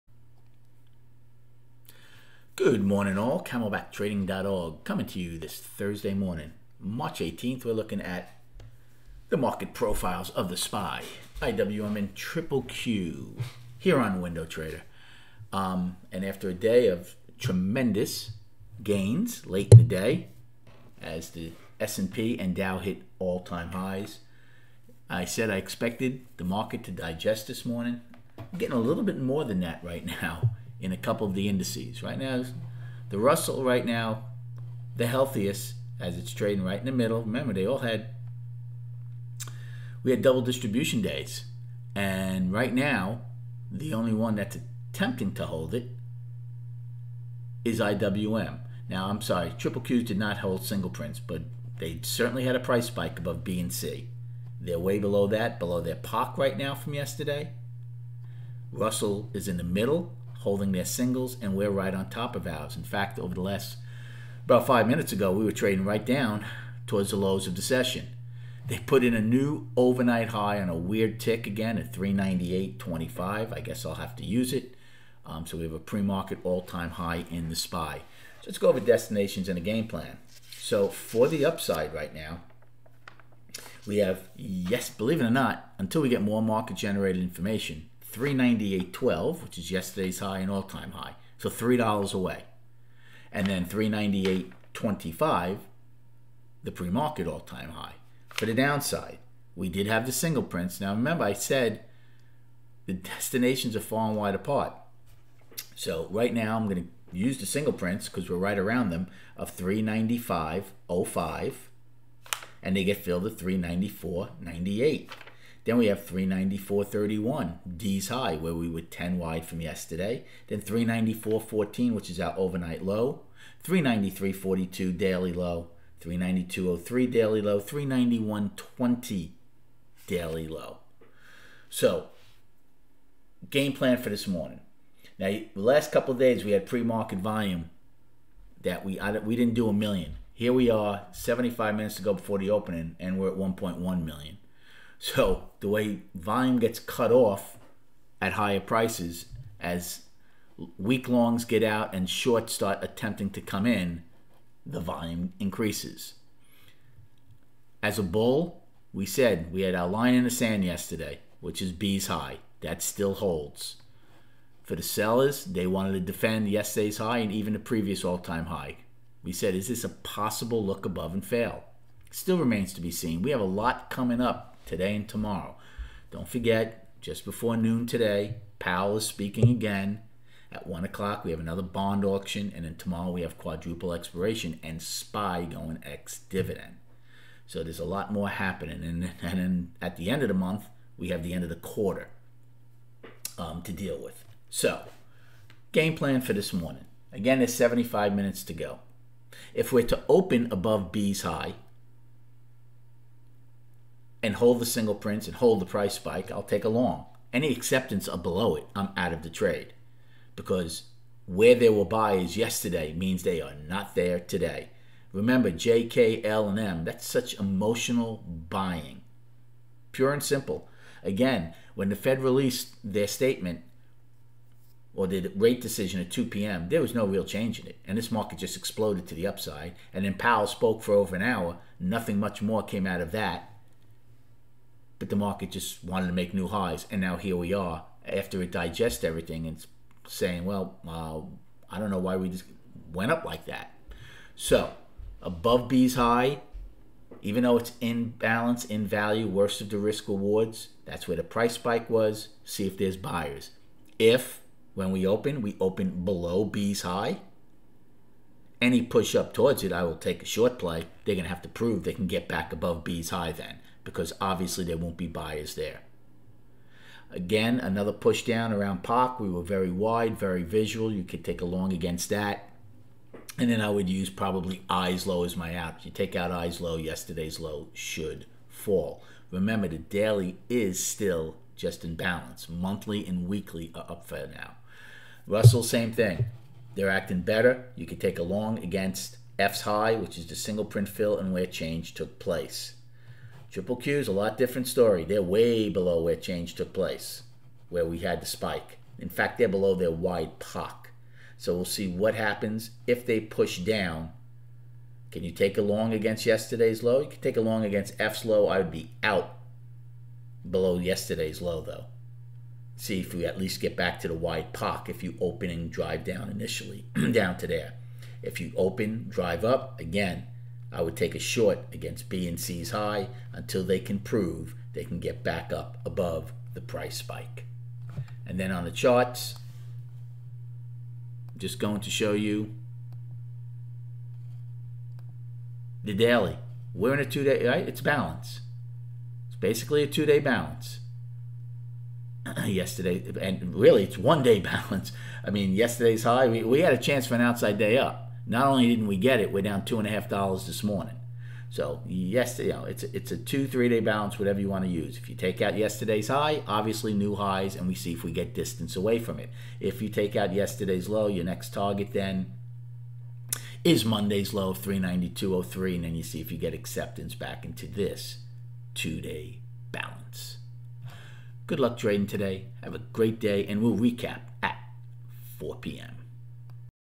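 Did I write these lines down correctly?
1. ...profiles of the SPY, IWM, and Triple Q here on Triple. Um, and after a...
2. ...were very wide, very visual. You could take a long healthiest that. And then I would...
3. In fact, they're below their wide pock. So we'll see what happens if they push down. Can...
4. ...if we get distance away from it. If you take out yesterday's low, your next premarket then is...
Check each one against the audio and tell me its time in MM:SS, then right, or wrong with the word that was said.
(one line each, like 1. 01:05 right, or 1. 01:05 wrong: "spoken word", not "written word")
1. 00:09 wrong: "WindoTrader", not "Triple"
2. 04:29 wrong: "against", not "healthiest"
3. 04:58 right
4. 05:57 wrong: "target", not "premarket".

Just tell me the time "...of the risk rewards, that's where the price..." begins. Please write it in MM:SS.
04:09.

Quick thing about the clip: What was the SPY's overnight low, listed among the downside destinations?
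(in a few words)
394.14.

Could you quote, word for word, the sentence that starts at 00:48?
Now, I'm sorry, Triple Qs did not hold single prints, but they certainly had a price spike above B and C.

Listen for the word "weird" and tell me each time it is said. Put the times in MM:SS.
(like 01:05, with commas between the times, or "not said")
01:10.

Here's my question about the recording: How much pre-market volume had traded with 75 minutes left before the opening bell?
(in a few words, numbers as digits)
1.1 million.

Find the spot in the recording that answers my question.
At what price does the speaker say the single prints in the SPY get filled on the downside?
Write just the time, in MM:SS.
01:53.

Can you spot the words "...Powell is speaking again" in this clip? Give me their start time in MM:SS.
02:58.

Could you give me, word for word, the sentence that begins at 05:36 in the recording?
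We're in a two day, right?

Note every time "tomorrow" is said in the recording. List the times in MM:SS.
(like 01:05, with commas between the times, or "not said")
02:55, 03:02.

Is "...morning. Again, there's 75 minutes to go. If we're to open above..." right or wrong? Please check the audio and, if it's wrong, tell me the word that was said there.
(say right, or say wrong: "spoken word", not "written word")
right.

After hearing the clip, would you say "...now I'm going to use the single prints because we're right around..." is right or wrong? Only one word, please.
right.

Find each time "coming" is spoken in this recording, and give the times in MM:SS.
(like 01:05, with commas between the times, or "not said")
00:04, 02:53.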